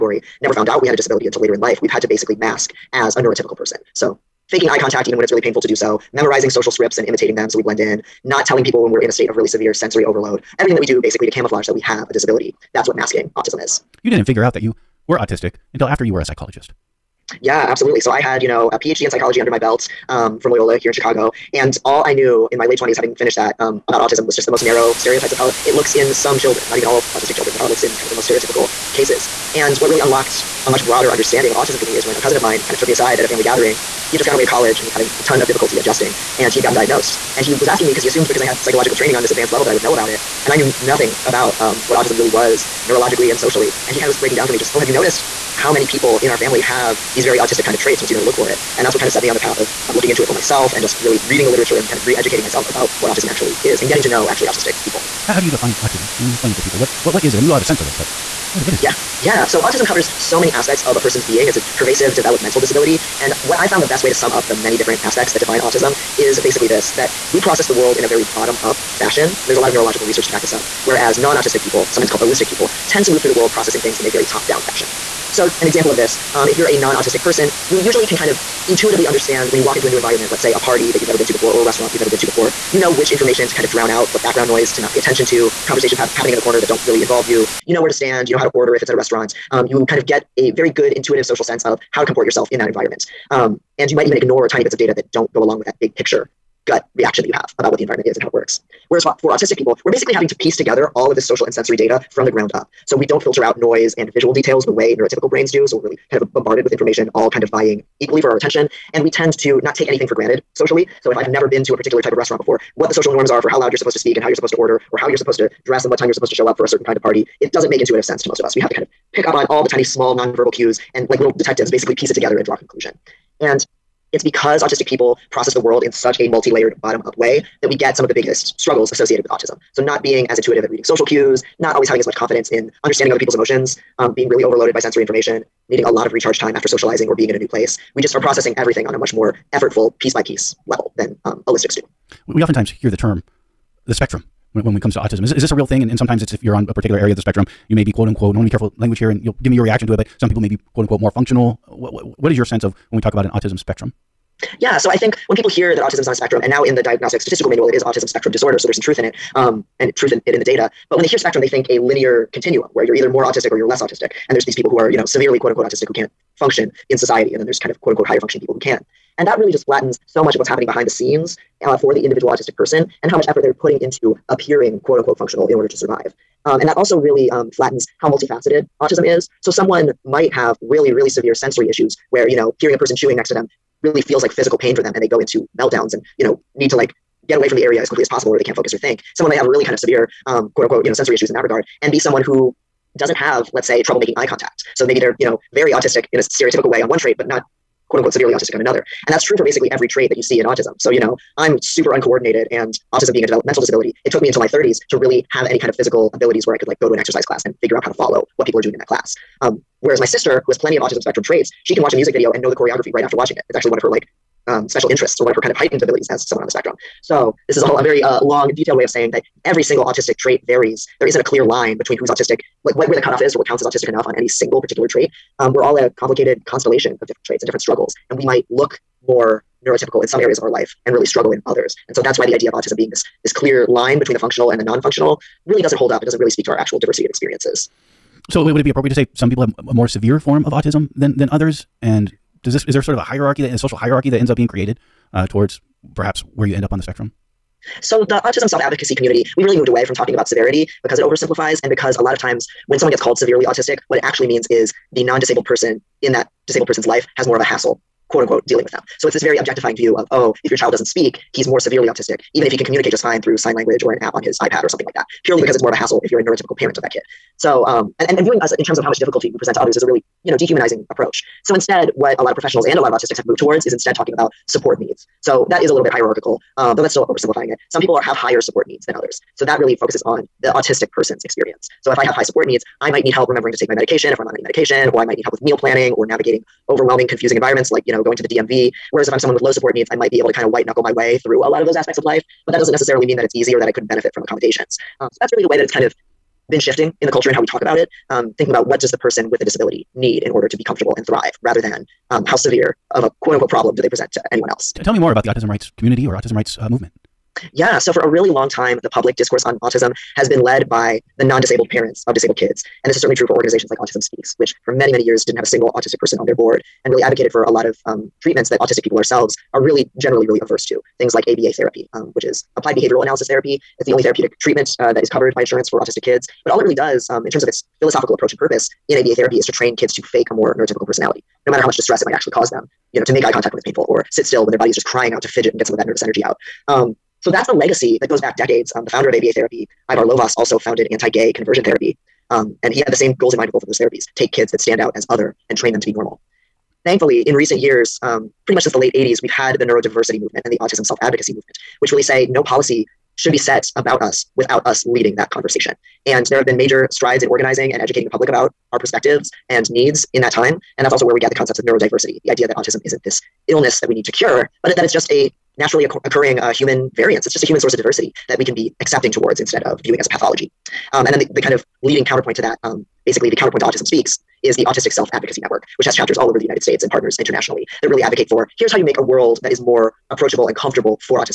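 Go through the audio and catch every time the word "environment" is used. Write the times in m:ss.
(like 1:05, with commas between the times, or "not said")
1:19, 1:32, 1:37, 4:47.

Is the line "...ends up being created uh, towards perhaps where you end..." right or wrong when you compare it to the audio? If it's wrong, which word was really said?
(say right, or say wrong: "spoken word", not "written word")
right.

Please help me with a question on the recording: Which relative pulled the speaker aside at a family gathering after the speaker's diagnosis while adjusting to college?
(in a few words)
A cousin.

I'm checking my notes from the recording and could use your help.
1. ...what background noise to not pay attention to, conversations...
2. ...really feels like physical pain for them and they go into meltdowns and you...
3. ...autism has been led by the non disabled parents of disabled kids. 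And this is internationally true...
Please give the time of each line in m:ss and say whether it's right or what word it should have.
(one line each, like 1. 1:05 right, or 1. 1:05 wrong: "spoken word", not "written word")
1. 1:24 right
2. 3:03 right
3. 5:09 wrong: "certainly", not "internationally".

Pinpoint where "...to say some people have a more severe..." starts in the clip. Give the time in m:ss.
3:58.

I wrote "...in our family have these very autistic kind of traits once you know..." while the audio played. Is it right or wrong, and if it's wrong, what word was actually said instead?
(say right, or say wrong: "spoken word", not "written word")
right.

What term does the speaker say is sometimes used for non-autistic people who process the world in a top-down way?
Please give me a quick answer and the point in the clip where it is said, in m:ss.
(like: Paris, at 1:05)
holistic people, at 1:12.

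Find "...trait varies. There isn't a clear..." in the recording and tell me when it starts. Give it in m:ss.
3:40.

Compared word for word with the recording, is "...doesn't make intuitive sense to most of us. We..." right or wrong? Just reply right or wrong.
right.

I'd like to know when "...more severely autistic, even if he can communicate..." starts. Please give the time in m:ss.
4:21.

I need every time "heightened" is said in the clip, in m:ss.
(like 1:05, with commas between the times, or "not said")
3:35.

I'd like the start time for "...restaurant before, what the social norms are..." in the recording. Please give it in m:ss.
1:52.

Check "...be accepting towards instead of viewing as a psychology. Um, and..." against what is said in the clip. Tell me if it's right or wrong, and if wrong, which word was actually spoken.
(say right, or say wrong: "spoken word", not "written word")
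wrong: "pathology", not "psychology".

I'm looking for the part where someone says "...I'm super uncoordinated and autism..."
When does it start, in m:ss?
3:21.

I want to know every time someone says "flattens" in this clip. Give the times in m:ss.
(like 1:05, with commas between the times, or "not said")
2:49, 2:57.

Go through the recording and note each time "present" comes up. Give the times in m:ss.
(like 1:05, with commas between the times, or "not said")
4:29, 5:03.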